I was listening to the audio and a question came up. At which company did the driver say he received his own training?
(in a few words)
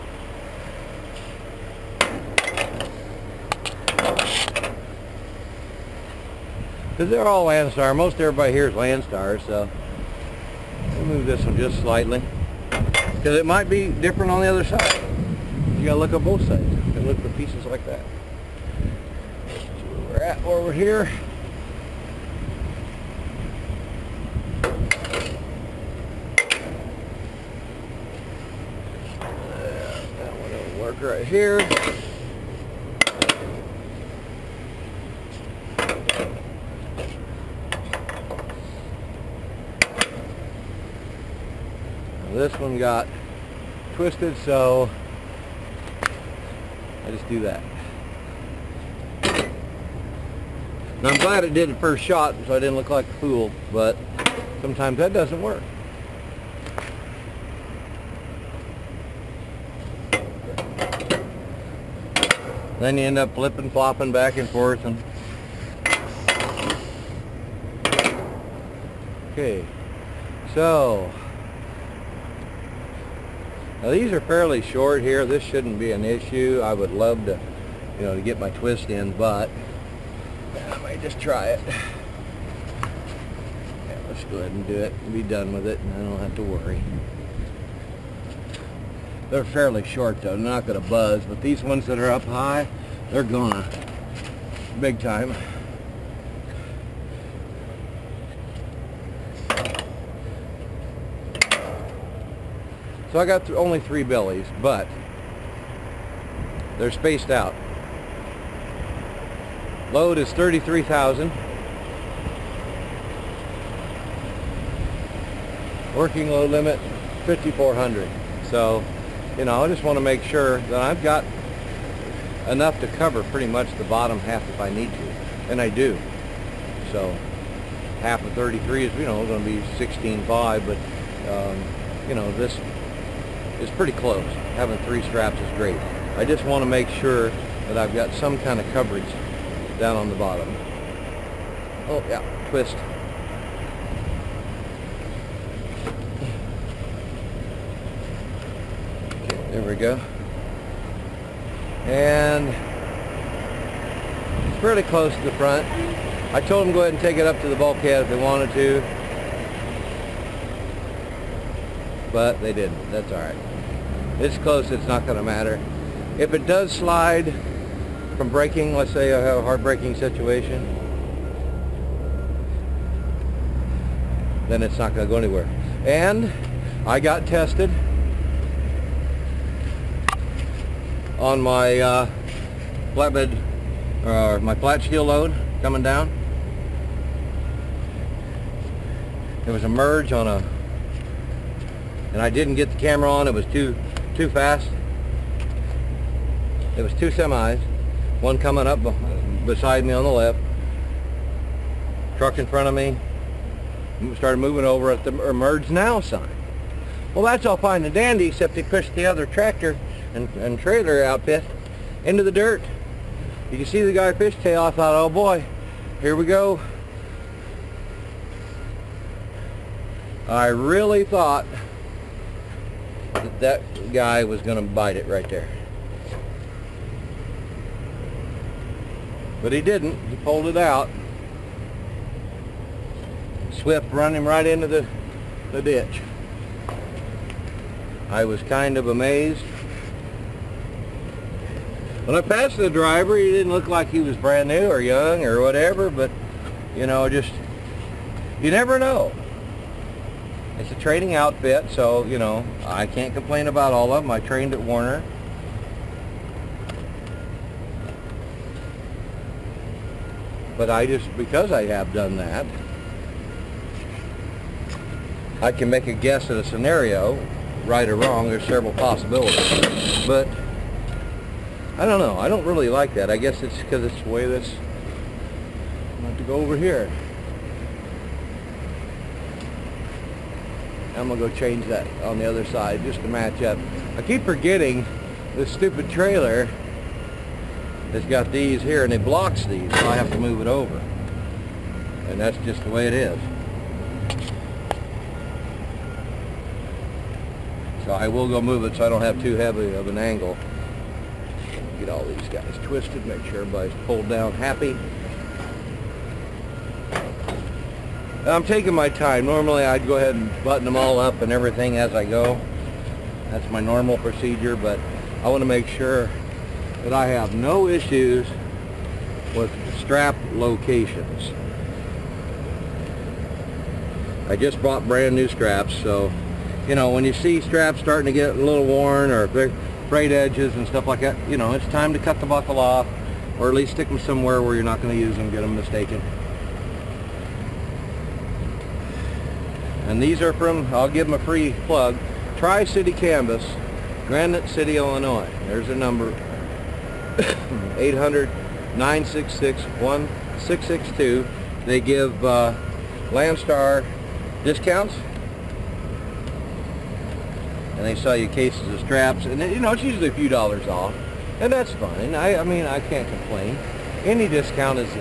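Werner.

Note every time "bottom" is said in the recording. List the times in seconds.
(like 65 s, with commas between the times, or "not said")
123 s, 140 s.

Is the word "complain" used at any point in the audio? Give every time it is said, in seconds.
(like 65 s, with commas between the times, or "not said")
253 s, 363 s.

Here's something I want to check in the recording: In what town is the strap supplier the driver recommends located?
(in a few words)
Granite City, Illinois.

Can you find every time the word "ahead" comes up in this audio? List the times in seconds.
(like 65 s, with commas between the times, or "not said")
84 s, 156 s, 309 s.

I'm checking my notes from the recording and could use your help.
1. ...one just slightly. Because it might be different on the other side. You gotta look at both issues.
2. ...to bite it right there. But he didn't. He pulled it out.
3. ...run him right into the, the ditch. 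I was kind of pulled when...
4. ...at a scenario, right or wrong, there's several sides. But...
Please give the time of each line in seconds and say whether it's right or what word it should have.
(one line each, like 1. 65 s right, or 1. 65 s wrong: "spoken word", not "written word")
1. 11 s wrong: "sides", not "issues"
2. 224 s right
3. 233 s wrong: "amazed", not "pulled"
4. 266 s wrong: "possibilities", not "sides".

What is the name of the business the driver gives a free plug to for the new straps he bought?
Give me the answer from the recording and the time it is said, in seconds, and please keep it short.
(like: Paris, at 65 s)
Tri-City Canvas, at 342 s.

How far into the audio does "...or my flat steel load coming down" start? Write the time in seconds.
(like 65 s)
184 s.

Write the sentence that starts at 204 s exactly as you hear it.
Started moving over at the merge now sign.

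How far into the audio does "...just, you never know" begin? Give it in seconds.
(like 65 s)
247 s.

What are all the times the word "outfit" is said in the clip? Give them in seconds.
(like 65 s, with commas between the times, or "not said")
211 s, 251 s.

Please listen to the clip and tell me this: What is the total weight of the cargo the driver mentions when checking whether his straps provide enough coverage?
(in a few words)
33,000.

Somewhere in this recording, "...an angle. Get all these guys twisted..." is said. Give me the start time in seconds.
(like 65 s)
299 s.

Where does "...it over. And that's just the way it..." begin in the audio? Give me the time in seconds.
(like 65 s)
290 s.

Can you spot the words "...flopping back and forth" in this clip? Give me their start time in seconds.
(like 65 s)
63 s.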